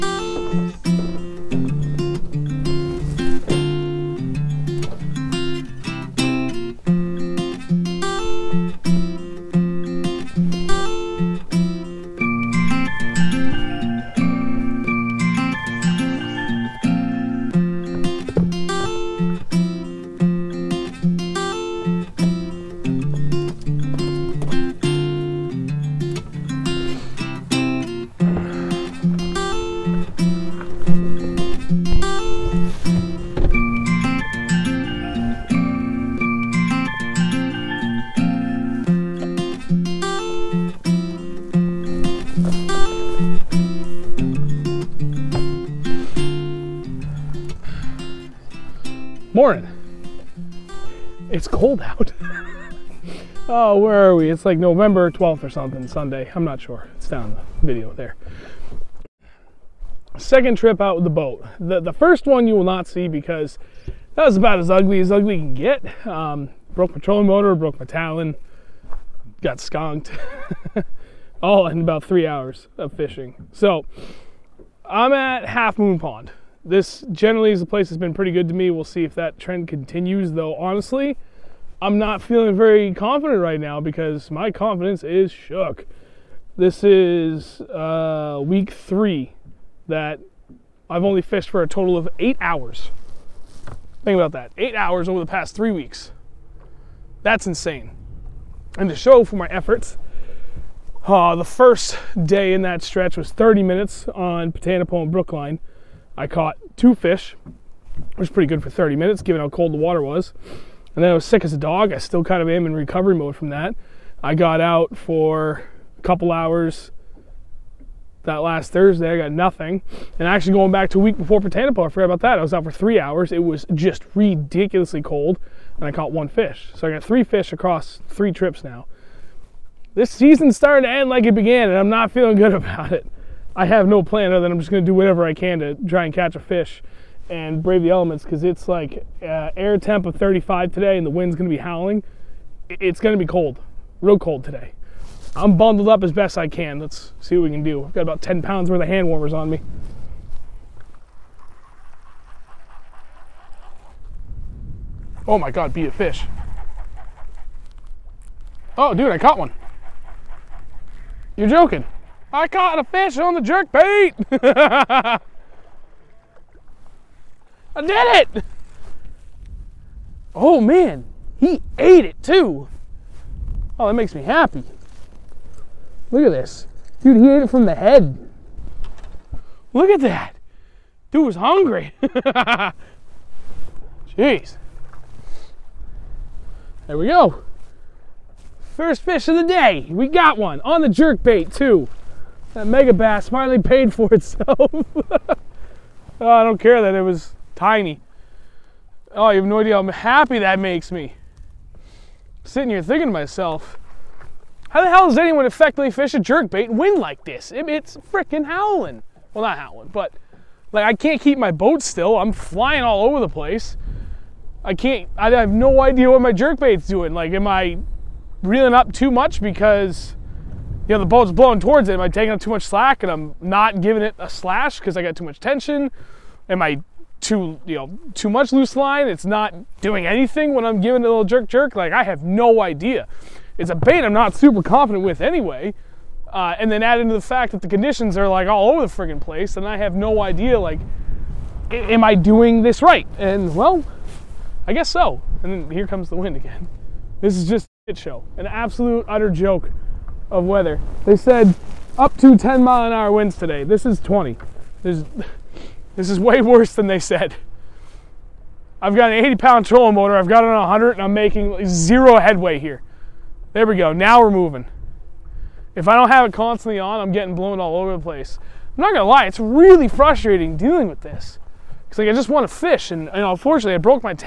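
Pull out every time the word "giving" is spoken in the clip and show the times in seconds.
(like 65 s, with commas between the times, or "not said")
223 s, 230 s.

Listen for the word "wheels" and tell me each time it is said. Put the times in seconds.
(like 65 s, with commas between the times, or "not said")
not said.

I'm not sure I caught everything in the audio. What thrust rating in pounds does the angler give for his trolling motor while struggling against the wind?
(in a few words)
80.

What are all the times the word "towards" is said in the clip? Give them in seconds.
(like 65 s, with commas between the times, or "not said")
221 s.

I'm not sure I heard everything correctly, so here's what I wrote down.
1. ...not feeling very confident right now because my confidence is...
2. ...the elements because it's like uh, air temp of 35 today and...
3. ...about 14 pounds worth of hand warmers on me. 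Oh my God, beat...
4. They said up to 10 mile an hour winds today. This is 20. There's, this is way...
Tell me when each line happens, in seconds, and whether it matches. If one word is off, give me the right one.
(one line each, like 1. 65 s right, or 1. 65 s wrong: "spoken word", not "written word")
1. 81 s right
2. 137 s right
3. 148 s wrong: "10", not "14"
4. 251 s right.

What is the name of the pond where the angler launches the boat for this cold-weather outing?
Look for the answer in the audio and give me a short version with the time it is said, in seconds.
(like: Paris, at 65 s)
Half Moon Pond, at 75 s.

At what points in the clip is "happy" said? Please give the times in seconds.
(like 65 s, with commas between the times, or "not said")
174 s, 199 s.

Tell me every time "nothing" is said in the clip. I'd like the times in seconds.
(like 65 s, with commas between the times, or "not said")
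119 s.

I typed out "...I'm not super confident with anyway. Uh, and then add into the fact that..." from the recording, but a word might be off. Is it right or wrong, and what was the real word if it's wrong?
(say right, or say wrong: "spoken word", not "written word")
right.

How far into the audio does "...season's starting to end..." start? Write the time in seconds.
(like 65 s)
130 s.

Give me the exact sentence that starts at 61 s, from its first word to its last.
The, the first one you will not see because that was about as ugly as ugly can get.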